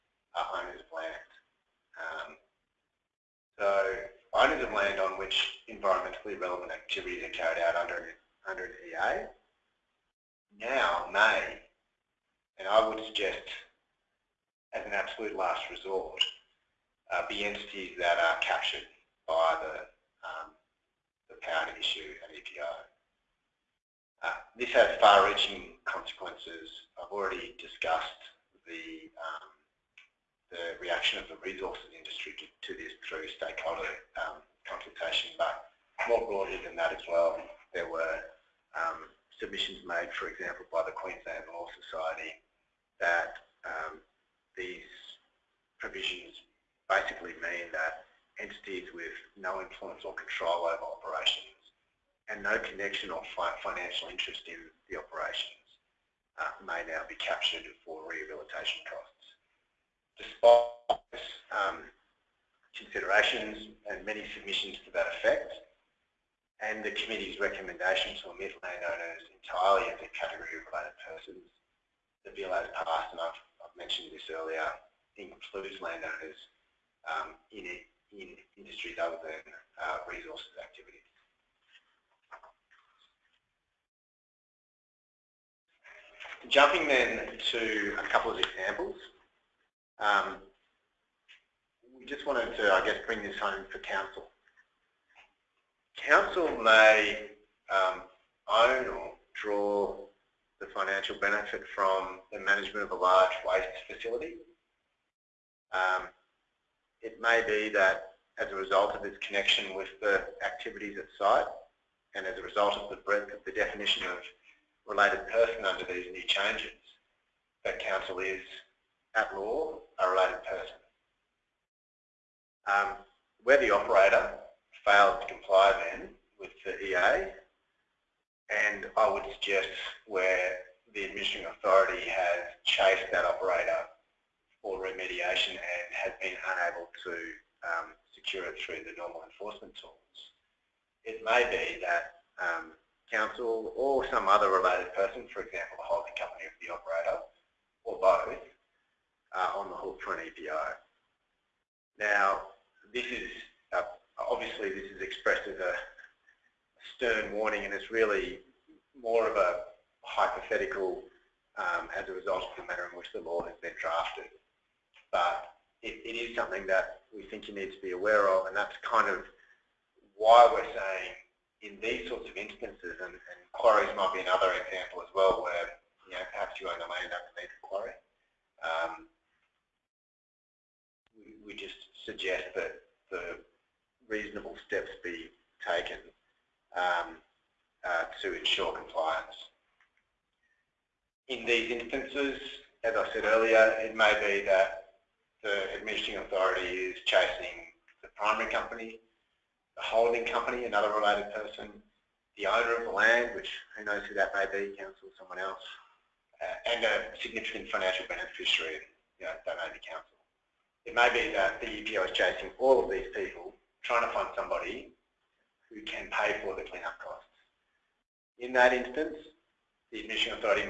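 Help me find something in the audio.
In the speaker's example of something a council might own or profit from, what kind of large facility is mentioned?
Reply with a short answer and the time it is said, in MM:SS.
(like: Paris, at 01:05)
waste facility, at 01:43.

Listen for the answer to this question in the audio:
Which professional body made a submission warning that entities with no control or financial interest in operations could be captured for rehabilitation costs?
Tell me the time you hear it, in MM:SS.
00:40.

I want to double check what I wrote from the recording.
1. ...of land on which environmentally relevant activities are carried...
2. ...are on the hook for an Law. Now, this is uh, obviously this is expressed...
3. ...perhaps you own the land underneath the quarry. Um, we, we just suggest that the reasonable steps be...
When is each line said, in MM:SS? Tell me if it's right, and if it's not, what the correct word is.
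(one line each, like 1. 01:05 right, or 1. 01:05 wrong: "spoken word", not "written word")
1. 00:04 right
2. 02:29 wrong: "EPO", not "Law"
3. 02:56 right.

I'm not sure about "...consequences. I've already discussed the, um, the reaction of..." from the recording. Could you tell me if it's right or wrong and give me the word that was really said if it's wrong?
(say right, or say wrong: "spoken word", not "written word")
right.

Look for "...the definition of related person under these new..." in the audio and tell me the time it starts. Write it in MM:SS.
01:53.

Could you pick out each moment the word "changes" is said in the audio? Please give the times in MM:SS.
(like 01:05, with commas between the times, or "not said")
01:56.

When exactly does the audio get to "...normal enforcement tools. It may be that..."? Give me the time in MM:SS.
02:18.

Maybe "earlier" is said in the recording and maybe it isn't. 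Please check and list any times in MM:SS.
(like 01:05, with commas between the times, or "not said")
01:14, 03:13.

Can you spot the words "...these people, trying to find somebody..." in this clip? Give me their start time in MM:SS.
03:32.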